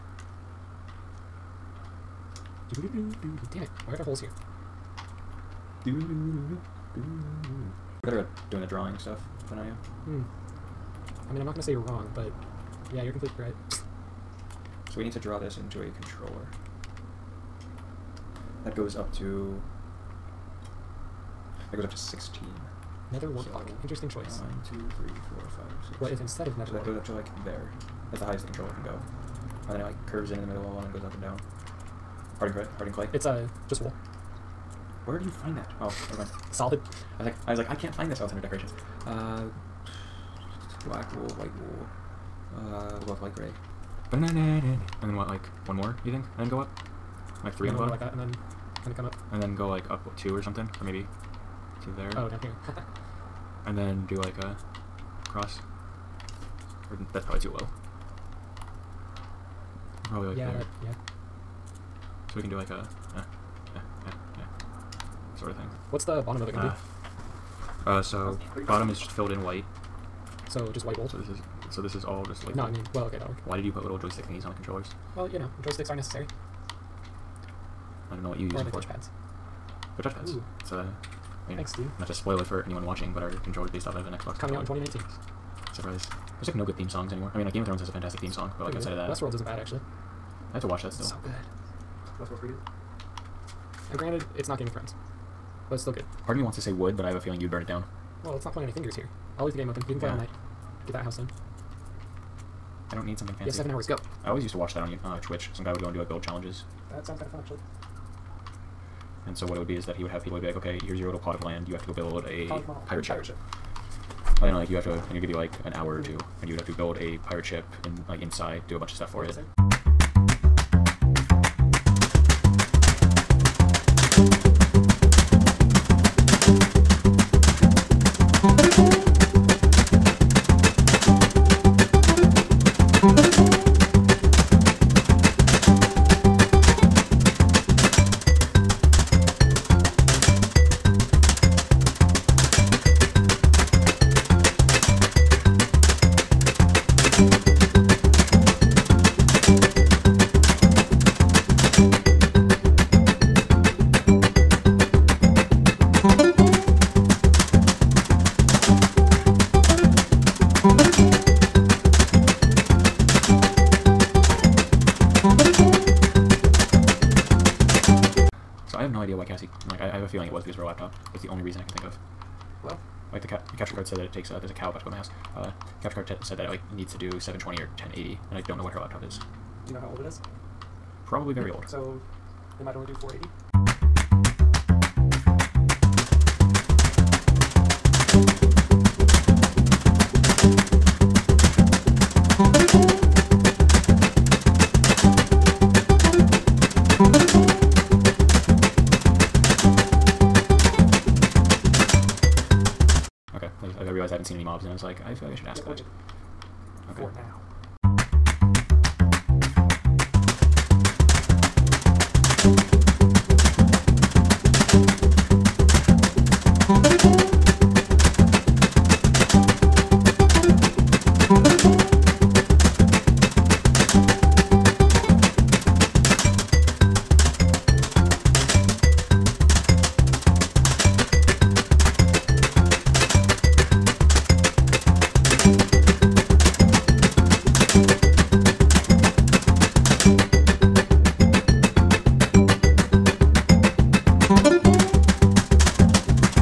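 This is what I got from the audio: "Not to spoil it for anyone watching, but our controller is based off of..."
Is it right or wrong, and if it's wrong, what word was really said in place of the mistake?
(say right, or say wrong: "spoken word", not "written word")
right.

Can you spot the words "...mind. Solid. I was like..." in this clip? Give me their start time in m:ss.
0:36.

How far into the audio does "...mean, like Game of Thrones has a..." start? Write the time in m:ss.
1:27.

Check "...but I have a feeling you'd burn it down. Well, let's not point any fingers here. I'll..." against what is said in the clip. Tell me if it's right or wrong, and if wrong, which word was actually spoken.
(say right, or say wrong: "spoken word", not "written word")
right.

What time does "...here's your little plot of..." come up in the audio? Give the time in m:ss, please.
1:50.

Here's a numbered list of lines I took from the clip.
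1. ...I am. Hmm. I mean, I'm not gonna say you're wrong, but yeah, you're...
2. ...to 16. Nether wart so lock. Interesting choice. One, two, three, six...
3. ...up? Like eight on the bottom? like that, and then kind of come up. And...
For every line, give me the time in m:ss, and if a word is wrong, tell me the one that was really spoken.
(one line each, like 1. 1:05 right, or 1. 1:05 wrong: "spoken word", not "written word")
1. 0:09 right
2. 0:21 wrong: "four", not "six"
3. 0:46 wrong: "three", not "eight".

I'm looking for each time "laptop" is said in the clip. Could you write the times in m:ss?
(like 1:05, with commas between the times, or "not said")
2:50, 2:58.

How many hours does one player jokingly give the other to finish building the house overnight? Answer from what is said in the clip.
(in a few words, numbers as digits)
7.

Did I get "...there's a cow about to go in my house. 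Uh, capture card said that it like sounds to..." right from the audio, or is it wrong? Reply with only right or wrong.
wrong.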